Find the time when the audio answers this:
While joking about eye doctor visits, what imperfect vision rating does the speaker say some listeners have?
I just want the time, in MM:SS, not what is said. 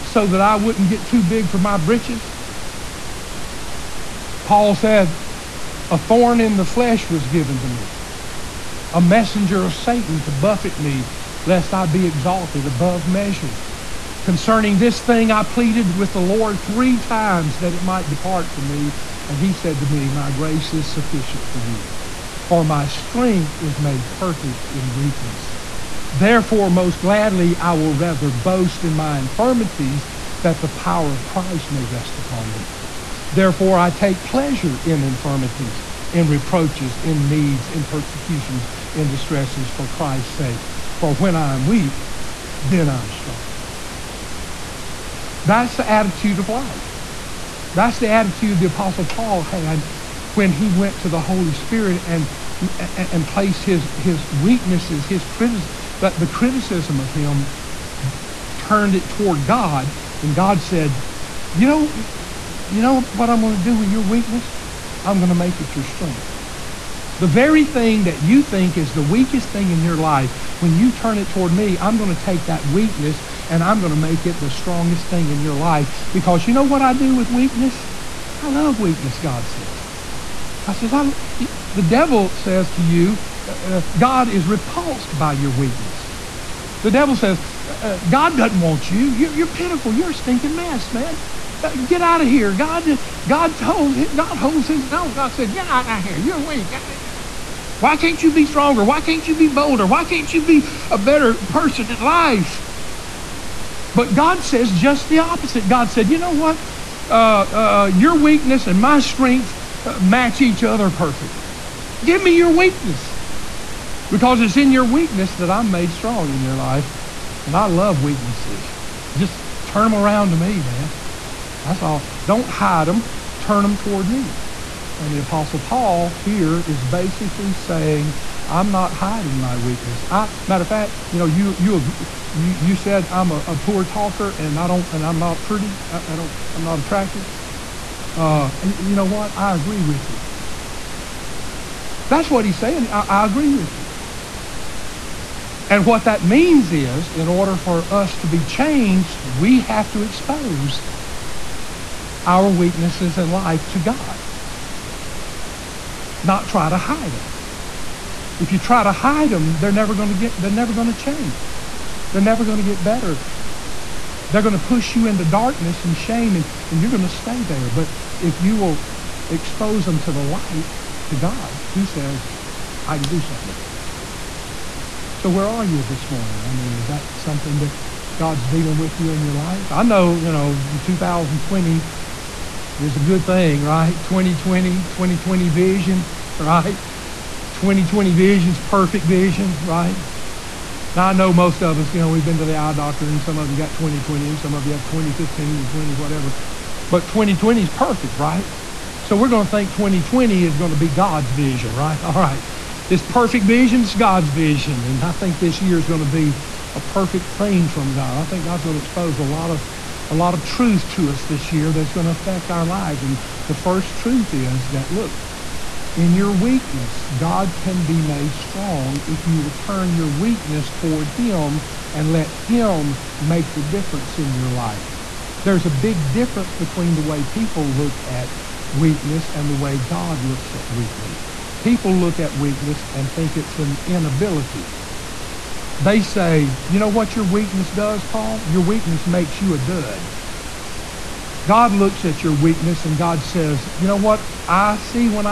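03:14.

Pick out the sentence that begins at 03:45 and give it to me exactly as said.
There's a big difference between the way people look at weakness and the way God looks at weakness.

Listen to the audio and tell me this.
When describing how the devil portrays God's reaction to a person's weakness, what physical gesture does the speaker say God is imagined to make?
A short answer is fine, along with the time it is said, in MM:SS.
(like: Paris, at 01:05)
Holds his nose, at 01:34.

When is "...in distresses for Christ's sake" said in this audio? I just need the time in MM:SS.
00:38.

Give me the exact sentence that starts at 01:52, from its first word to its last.
Give me your weakness because it's in your weakness that I'm made strong in your life.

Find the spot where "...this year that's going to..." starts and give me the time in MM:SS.
03:31.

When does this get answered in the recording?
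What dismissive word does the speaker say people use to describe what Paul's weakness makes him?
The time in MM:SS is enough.
03:59.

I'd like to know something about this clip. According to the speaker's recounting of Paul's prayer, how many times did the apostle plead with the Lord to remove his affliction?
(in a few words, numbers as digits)
3.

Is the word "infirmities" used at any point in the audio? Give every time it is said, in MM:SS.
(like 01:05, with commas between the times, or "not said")
00:29, 00:35.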